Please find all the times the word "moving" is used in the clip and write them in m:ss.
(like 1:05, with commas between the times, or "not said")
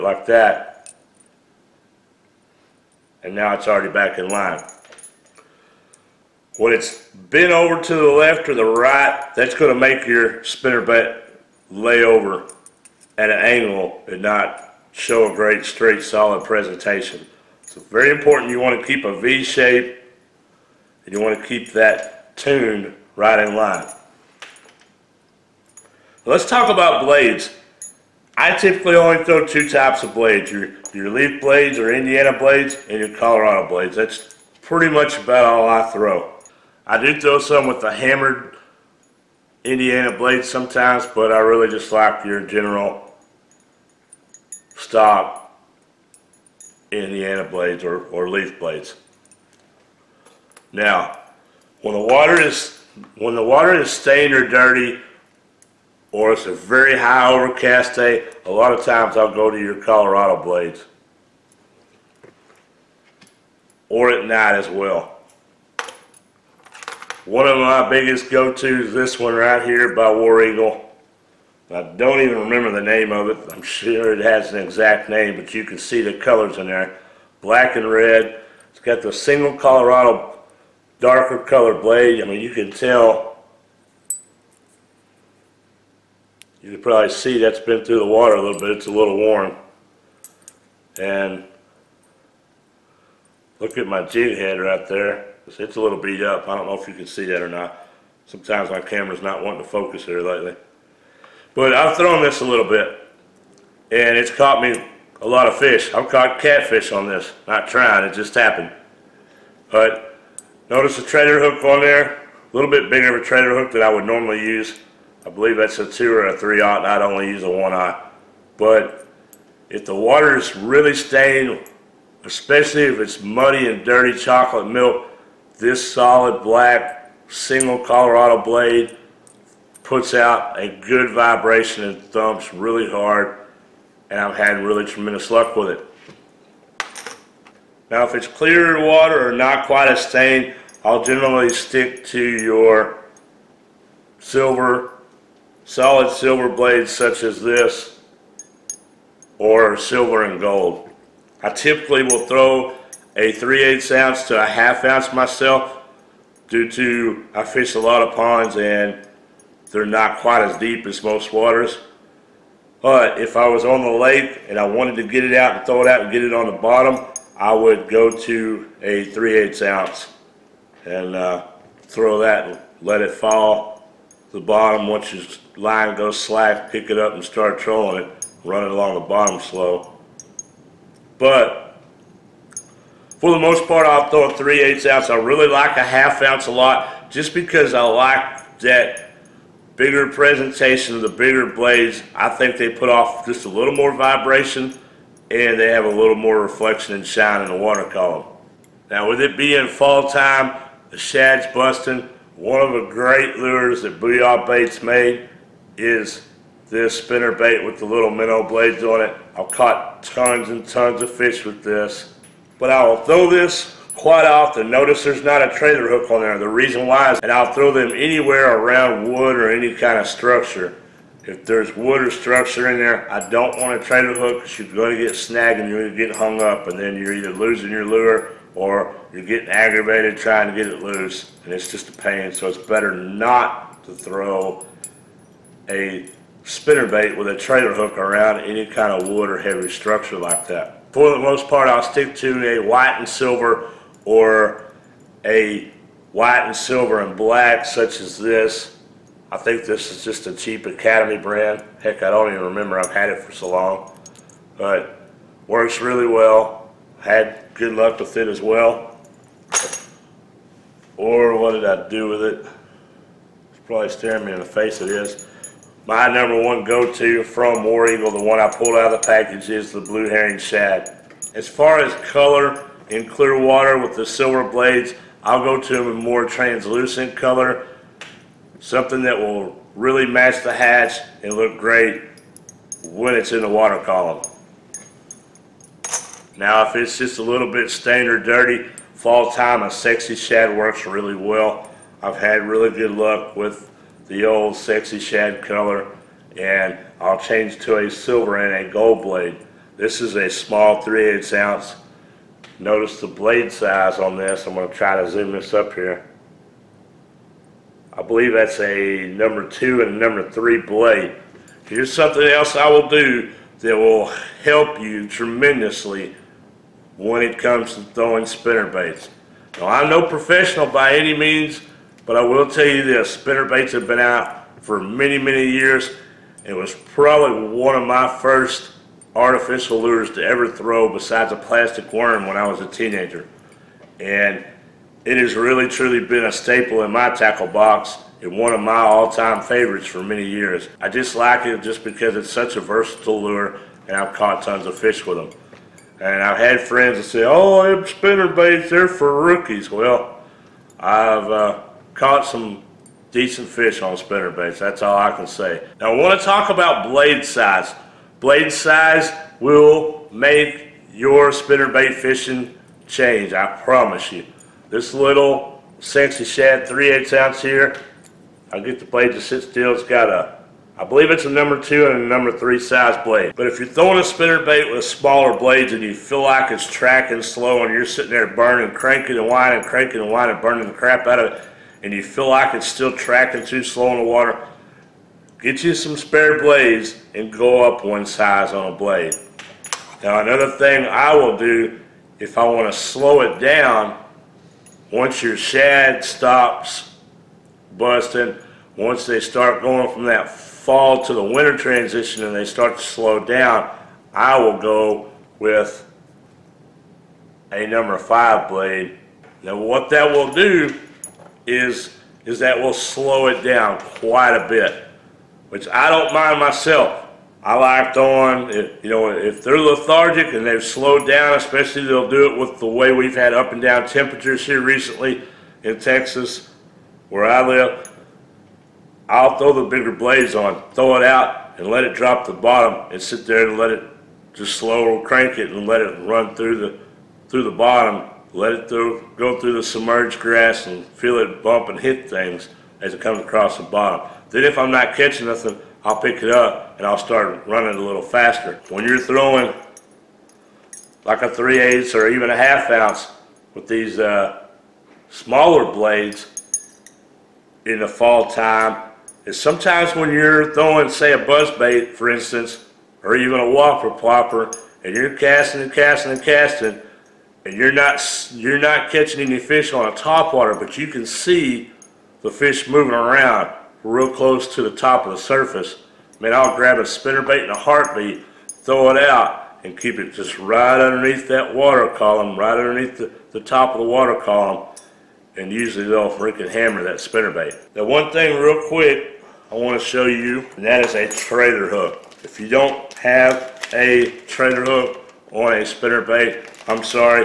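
7:52.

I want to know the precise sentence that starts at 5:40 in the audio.
I just like it just because it's such a versatile lure and I've caught tons of fish with them.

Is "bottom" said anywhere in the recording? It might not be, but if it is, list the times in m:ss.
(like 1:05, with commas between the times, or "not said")
2:46, 2:54, 2:59, 7:12, 7:17, 7:23.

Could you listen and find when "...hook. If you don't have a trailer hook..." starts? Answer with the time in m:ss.
8:11.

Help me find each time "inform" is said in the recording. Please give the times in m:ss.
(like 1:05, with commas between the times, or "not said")
not said.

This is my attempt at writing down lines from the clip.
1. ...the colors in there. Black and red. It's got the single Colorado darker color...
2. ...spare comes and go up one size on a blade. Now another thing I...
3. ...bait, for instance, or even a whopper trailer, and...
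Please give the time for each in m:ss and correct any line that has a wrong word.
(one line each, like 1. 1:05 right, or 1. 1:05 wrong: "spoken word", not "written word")
1. 1:16 right
2. 6:25 wrong: "blades", not "comes"
3. 7:41 wrong: "plopper", not "trailer".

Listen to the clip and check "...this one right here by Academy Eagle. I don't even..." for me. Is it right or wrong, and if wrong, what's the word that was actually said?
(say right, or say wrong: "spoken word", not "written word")
wrong: "War", not "Academy".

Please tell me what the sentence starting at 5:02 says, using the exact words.
Notice the blade size on this.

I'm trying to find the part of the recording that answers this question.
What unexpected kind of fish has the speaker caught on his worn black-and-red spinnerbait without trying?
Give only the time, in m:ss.
1:46.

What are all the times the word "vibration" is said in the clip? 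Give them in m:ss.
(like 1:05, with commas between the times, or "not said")
2:11, 3:13.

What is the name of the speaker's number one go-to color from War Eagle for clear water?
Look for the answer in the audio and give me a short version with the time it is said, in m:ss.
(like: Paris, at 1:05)
Blue Herring Shad, at 4:29.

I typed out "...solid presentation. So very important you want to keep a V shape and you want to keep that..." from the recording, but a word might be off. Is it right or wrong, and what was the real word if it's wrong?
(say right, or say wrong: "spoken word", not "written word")
right.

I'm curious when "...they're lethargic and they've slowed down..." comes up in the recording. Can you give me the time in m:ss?
6:59.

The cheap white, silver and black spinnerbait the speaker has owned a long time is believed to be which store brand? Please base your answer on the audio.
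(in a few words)
Academy.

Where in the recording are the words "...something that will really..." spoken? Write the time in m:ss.
4:38.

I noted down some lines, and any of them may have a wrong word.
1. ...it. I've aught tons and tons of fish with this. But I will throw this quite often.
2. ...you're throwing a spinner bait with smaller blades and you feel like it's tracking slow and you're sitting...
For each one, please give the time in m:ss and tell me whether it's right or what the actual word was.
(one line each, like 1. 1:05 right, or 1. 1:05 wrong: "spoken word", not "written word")
1. 3:28 wrong: "caught", not "aught"
2. 6:13 right.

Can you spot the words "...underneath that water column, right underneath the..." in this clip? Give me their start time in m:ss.
8:00.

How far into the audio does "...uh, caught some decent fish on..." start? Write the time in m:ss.
5:51.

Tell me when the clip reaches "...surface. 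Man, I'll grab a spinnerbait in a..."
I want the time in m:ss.
7:55.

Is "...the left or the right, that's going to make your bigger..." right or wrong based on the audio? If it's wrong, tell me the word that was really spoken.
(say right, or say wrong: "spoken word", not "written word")
wrong: "spinner", not "bigger".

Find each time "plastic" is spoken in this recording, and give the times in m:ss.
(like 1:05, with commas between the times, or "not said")
5:31.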